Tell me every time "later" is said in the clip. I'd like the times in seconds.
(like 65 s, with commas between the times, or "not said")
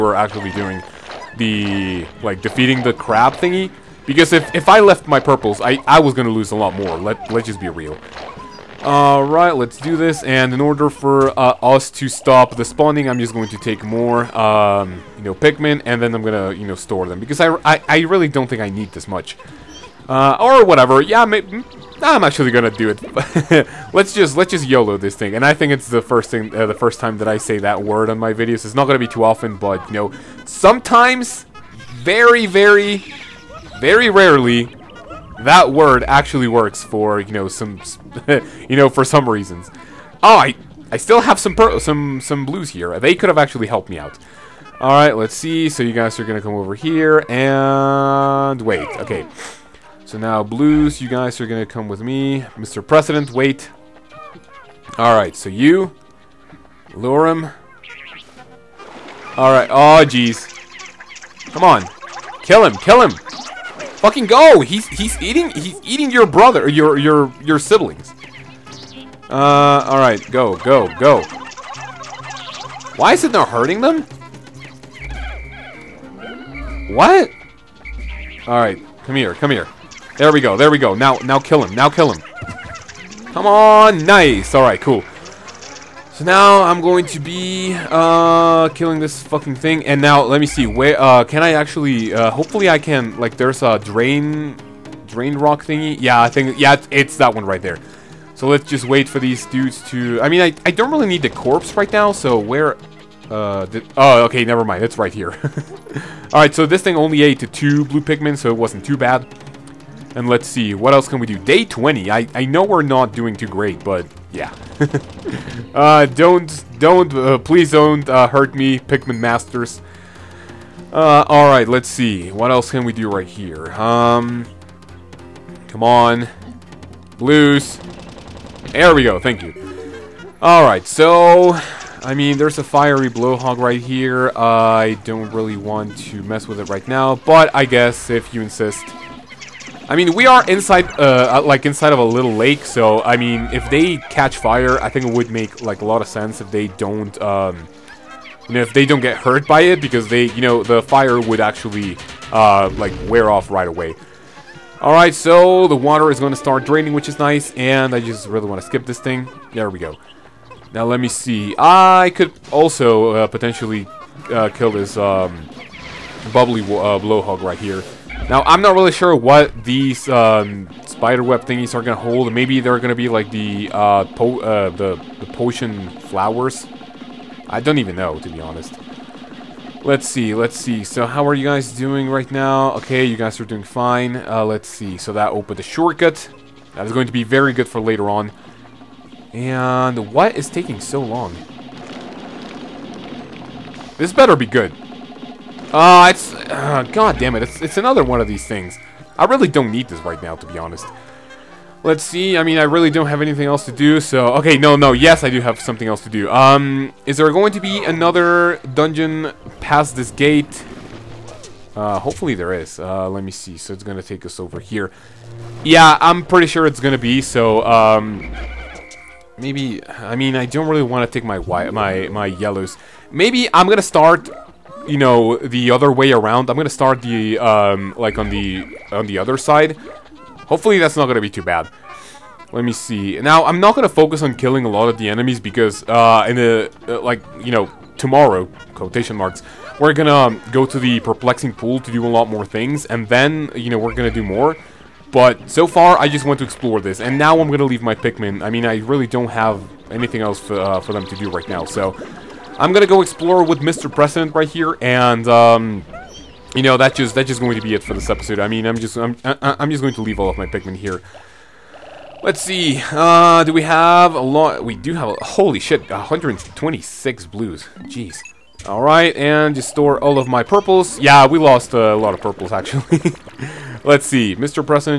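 187 s.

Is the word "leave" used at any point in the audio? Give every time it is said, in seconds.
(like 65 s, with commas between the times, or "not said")
247 s, 260 s.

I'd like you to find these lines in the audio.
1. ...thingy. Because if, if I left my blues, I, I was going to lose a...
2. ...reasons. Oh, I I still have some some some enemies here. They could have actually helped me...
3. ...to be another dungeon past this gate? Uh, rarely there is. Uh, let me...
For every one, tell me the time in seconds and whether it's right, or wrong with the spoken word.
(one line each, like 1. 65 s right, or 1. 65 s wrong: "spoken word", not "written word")
1. 3 s wrong: "purples", not "blues"
2. 39 s wrong: "blues", not "enemies"
3. 207 s wrong: "hopefully", not "rarely".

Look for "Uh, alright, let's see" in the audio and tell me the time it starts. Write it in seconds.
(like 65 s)
120 s.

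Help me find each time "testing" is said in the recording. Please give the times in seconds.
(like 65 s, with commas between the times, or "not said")
not said.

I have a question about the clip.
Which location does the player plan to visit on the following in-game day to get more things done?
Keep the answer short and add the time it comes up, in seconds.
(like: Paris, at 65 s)
Perplexing Pool, at 241 s.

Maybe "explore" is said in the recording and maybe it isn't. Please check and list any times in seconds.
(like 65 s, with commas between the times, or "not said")
246 s, 253 s.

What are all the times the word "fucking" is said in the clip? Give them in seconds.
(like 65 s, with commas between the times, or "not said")
64 s, 89 s.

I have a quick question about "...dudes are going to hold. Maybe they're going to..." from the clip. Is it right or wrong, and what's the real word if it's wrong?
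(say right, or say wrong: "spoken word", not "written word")
wrong: "thingies", not "dudes".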